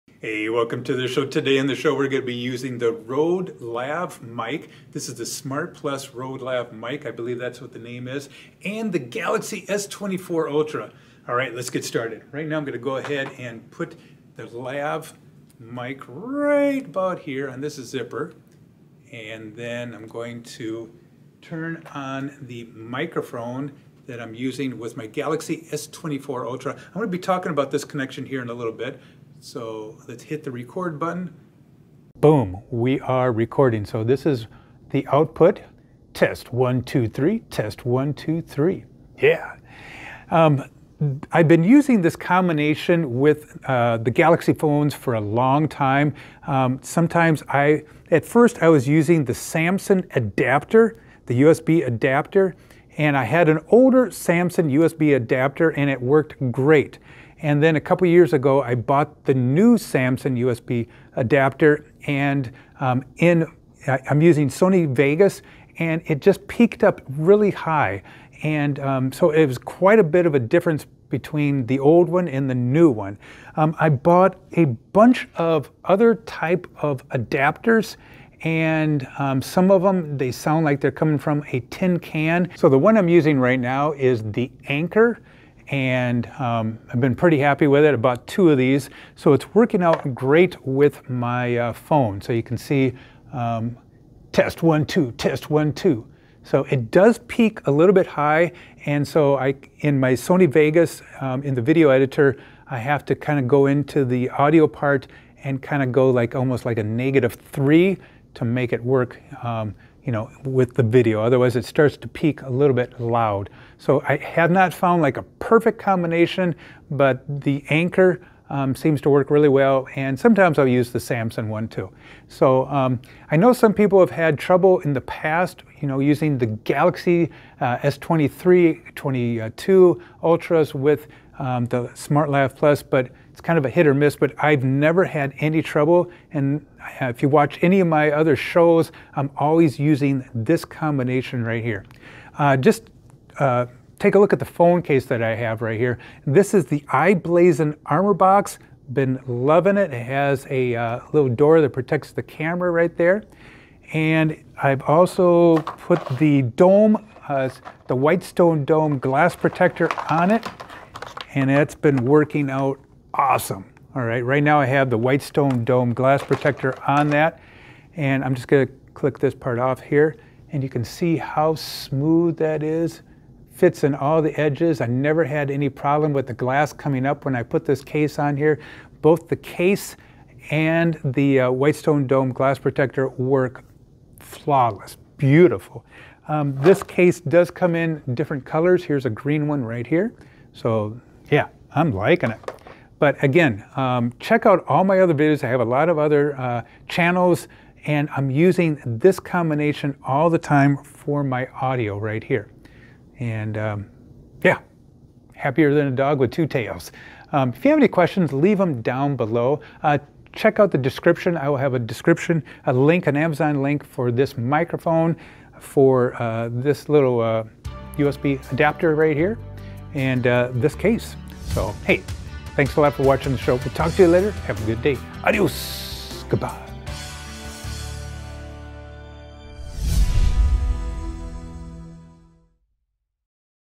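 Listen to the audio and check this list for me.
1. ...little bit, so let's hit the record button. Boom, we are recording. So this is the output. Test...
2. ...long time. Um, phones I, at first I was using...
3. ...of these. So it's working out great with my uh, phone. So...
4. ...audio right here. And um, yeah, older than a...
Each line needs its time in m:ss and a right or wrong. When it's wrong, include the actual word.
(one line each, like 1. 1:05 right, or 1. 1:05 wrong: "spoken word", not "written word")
1. 0:28 right
2. 0:45 wrong: "sometimes", not "phones"
3. 1:28 right
4. 3:21 wrong: "happier", not "older".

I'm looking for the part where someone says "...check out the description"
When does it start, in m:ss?
3:30.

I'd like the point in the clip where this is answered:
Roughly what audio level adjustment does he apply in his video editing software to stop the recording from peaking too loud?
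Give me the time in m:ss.
1:46.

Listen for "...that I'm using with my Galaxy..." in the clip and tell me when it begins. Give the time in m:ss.
0:24.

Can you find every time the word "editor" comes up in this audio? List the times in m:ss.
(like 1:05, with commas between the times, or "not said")
1:41.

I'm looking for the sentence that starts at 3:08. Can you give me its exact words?
Here's a green one right here.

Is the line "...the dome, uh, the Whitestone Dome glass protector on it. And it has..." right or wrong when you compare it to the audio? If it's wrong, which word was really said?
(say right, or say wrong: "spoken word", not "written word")
right.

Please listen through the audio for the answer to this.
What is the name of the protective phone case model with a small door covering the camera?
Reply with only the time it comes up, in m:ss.
2:26.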